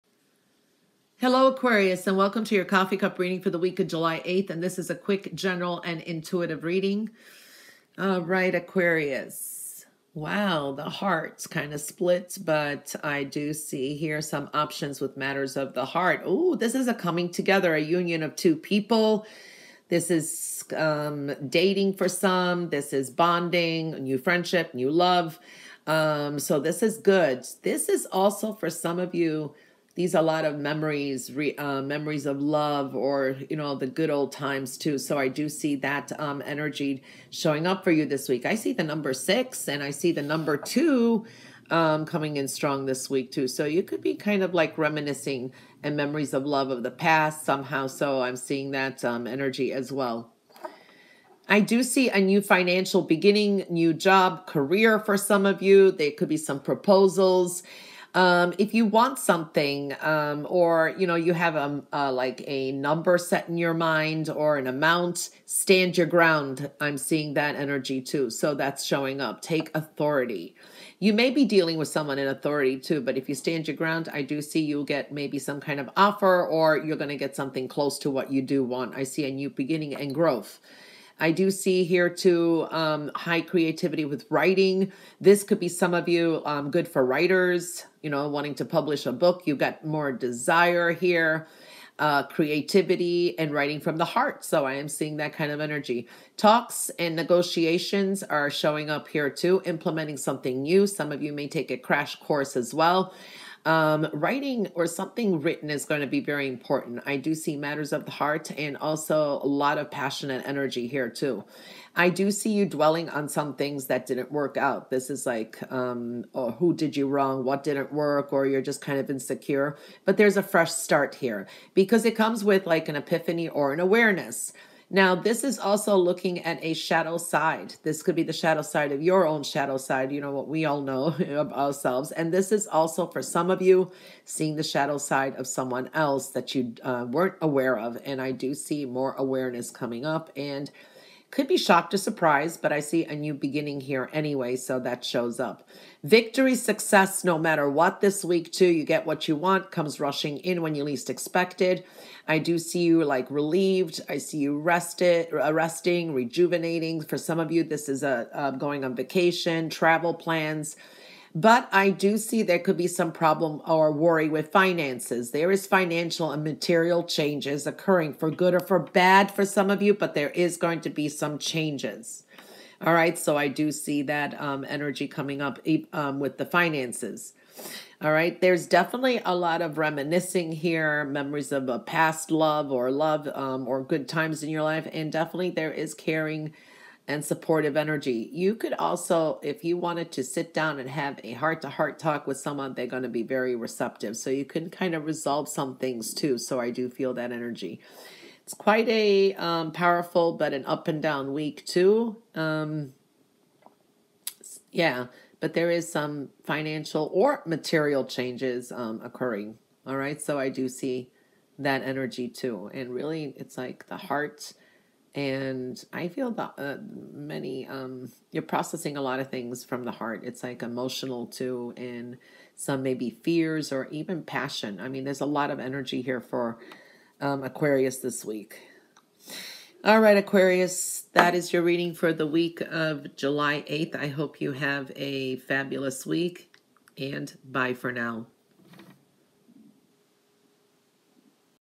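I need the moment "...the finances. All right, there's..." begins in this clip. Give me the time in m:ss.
2:56.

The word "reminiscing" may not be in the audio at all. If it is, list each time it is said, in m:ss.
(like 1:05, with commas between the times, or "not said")
0:44, 2:59.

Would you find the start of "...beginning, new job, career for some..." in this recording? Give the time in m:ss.
0:53.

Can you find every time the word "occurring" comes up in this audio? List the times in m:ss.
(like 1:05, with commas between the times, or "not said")
2:47, 3:29.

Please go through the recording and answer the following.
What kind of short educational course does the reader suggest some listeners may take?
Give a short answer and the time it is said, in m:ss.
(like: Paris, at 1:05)
crash course, at 1:41.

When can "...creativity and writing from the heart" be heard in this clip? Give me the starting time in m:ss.
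1:32.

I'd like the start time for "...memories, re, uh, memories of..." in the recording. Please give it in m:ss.
0:30.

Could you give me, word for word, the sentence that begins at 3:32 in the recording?
And really, it's like the heart and I feel that uh, many um, you're processing a lot of things from the heart.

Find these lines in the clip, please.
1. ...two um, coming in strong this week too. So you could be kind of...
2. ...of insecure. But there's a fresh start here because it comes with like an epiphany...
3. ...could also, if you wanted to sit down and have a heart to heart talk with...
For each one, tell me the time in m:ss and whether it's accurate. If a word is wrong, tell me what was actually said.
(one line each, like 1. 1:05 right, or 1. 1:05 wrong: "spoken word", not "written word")
1. 0:40 right
2. 1:58 right
3. 3:08 right.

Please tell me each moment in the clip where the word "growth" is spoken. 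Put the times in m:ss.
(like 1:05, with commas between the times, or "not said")
1:20.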